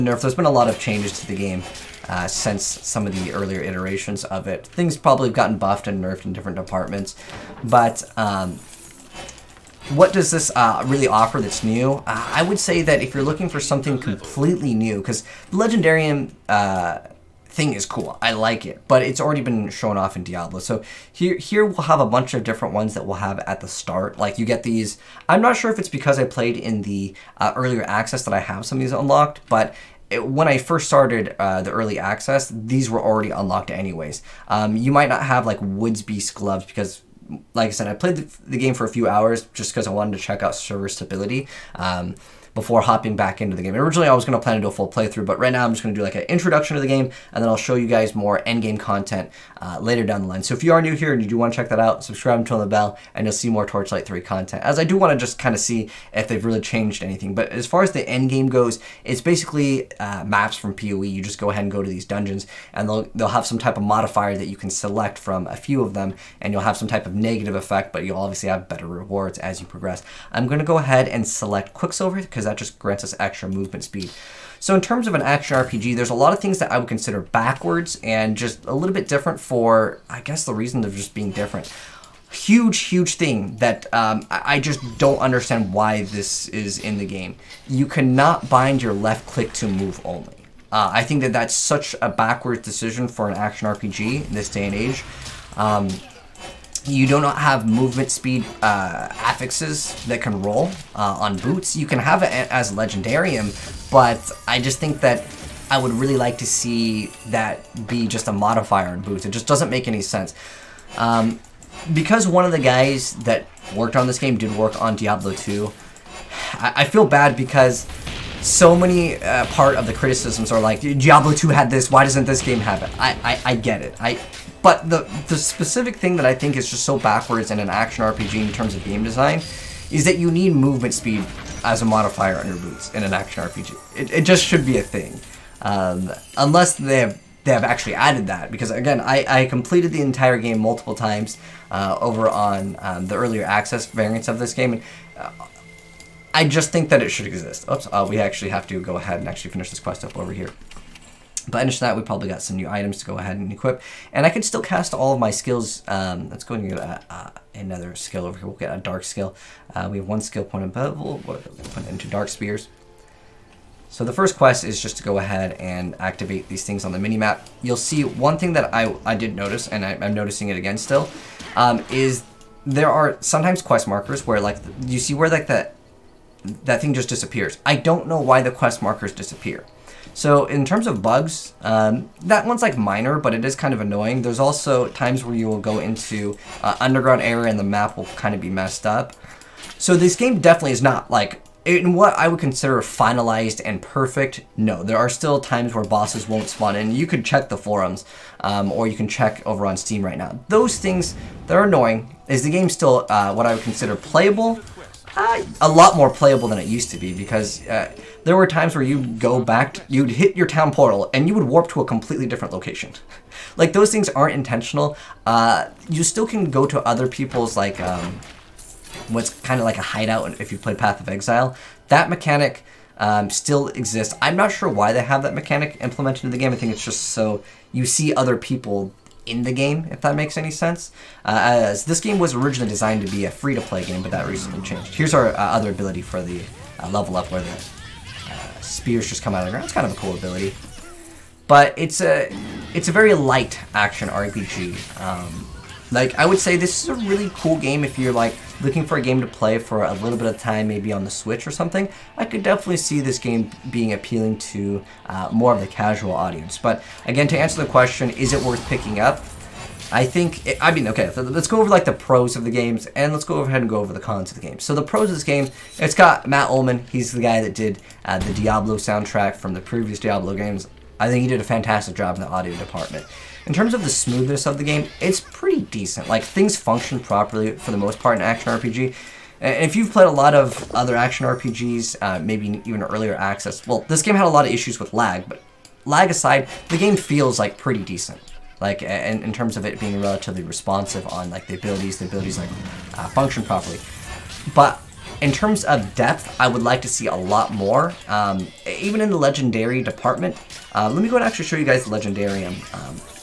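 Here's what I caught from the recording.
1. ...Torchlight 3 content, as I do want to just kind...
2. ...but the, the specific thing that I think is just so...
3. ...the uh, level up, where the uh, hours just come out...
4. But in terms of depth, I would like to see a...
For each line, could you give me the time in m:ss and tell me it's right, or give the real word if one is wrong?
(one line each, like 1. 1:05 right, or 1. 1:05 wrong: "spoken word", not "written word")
1. 0:53 right
2. 2:04 right
3. 3:56 wrong: "spears", not "hours"
4. 4:54 right.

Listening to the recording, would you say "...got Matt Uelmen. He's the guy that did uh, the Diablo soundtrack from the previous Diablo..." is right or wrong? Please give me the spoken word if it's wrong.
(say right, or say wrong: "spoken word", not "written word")
right.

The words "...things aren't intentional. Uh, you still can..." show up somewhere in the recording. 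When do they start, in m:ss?
3:33.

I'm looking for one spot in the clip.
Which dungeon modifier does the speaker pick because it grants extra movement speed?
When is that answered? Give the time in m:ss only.
1:11.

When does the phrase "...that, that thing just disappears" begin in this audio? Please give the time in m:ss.
2:55.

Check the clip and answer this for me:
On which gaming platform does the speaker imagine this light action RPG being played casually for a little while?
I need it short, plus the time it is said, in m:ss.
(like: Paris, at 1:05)
Switch, at 4:11.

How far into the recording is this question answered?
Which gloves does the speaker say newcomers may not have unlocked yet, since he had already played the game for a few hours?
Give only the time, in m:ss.
0:35.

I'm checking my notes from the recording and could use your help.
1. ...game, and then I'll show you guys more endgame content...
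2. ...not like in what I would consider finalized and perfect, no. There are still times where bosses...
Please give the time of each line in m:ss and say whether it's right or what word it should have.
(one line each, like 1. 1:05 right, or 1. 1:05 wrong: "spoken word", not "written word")
1. 0:46 right
2. 3:10 right.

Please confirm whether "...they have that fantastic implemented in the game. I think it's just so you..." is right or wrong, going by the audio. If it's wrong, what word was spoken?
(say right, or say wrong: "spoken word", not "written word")
wrong: "mechanic", not "fantastic".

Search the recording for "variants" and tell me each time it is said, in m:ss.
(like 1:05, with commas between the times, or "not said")
2:23.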